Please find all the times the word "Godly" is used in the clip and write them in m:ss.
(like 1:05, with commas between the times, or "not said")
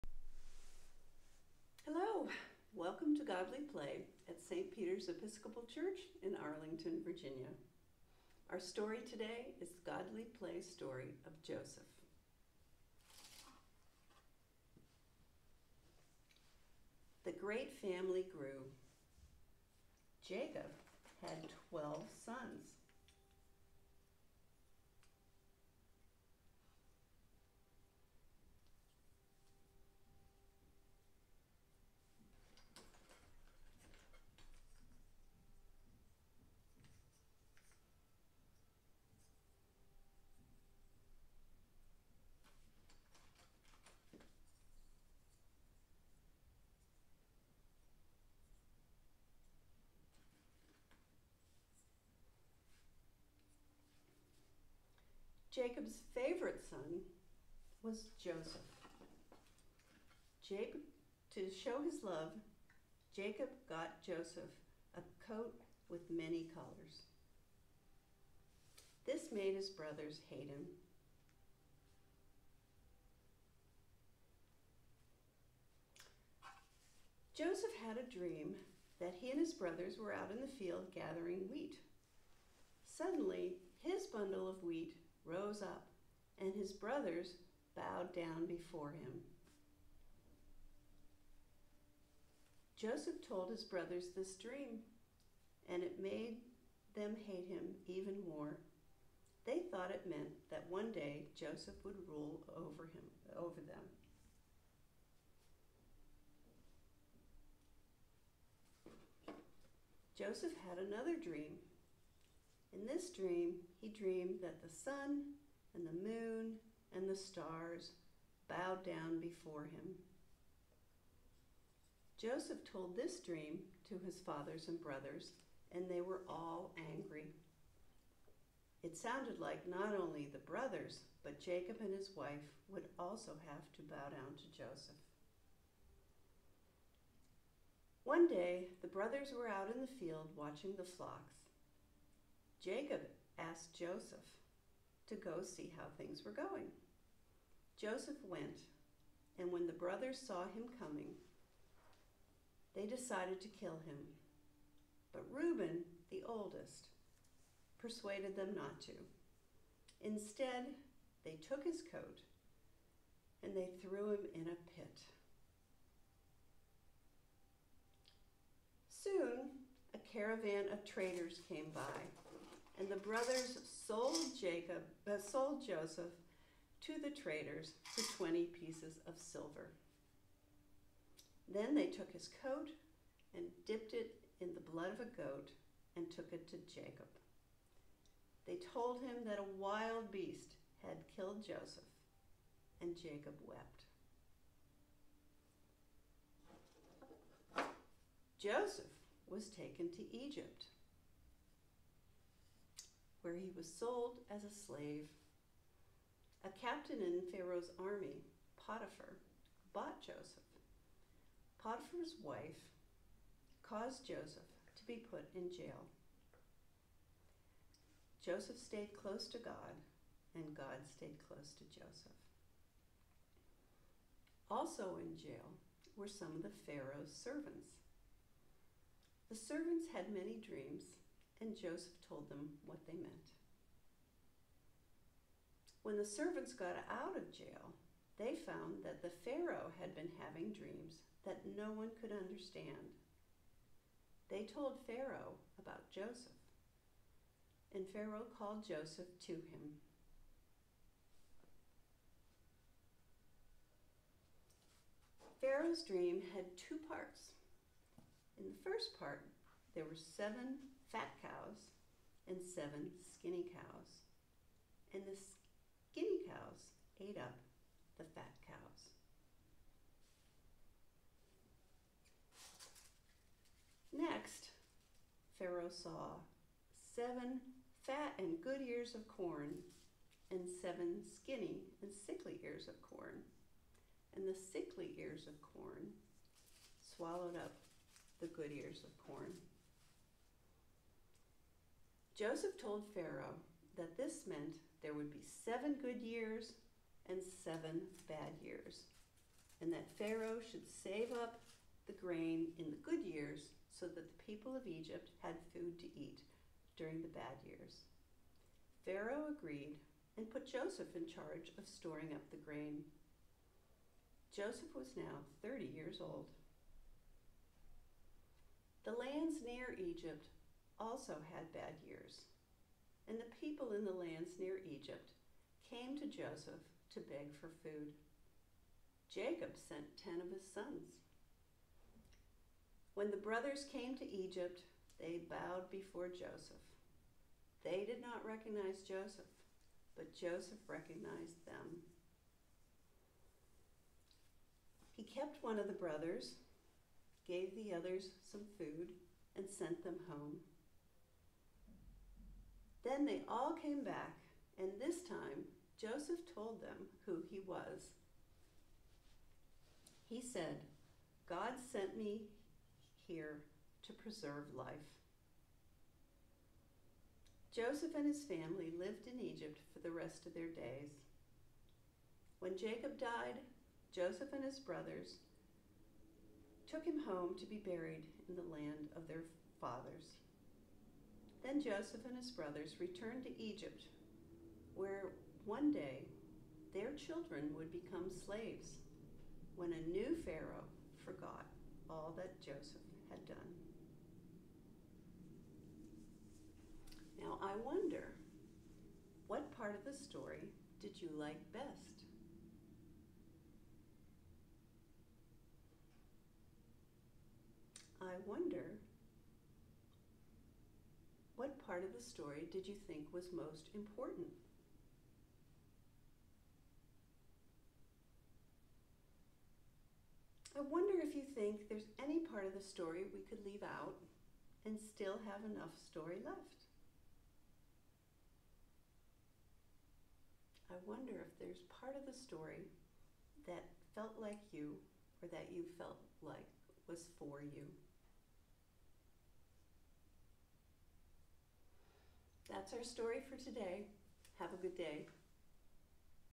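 0:03, 0:09.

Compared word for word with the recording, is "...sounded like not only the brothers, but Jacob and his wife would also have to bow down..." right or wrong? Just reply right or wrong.
right.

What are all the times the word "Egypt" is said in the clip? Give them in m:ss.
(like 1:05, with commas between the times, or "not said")
3:20, 5:04, 5:19, 5:24, 5:34, 6:09, 6:23.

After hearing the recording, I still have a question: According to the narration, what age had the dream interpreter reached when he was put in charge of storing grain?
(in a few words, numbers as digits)
30.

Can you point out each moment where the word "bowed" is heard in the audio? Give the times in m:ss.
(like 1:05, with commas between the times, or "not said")
1:27, 1:58, 5:35.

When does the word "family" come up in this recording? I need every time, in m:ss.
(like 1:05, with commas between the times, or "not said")
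0:17, 6:08.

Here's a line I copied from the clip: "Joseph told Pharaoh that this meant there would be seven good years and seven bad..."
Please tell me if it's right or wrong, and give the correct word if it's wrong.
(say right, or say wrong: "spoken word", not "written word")
right.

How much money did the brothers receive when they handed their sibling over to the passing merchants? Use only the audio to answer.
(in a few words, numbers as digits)
20 pieces of silver.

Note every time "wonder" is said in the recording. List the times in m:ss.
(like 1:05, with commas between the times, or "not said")
6:37, 6:48, 7:00, 7:10.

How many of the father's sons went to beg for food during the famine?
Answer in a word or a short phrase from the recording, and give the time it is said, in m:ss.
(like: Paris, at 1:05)
10, at 5:30.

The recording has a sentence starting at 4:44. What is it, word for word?
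And the sickly ears of corn swallowed up the good ears of corn.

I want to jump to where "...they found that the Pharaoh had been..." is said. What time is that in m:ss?
3:58.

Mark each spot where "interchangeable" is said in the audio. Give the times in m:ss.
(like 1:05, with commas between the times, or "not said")
not said.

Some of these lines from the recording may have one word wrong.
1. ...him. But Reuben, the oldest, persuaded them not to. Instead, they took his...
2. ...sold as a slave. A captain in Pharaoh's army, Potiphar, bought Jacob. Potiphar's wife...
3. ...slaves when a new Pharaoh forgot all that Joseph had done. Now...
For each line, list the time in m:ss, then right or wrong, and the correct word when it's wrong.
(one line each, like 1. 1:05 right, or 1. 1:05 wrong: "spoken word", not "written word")
1. 2:33 right
2. 3:23 wrong: "Joseph", not "Jacob"
3. 6:28 right.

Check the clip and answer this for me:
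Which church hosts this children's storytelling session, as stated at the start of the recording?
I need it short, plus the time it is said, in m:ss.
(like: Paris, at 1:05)
St. Peter's Episcopal Church, at 0:04.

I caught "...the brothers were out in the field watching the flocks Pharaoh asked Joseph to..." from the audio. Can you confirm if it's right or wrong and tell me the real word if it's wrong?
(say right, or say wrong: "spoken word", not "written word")
wrong: "Jacob", not "Pharaoh".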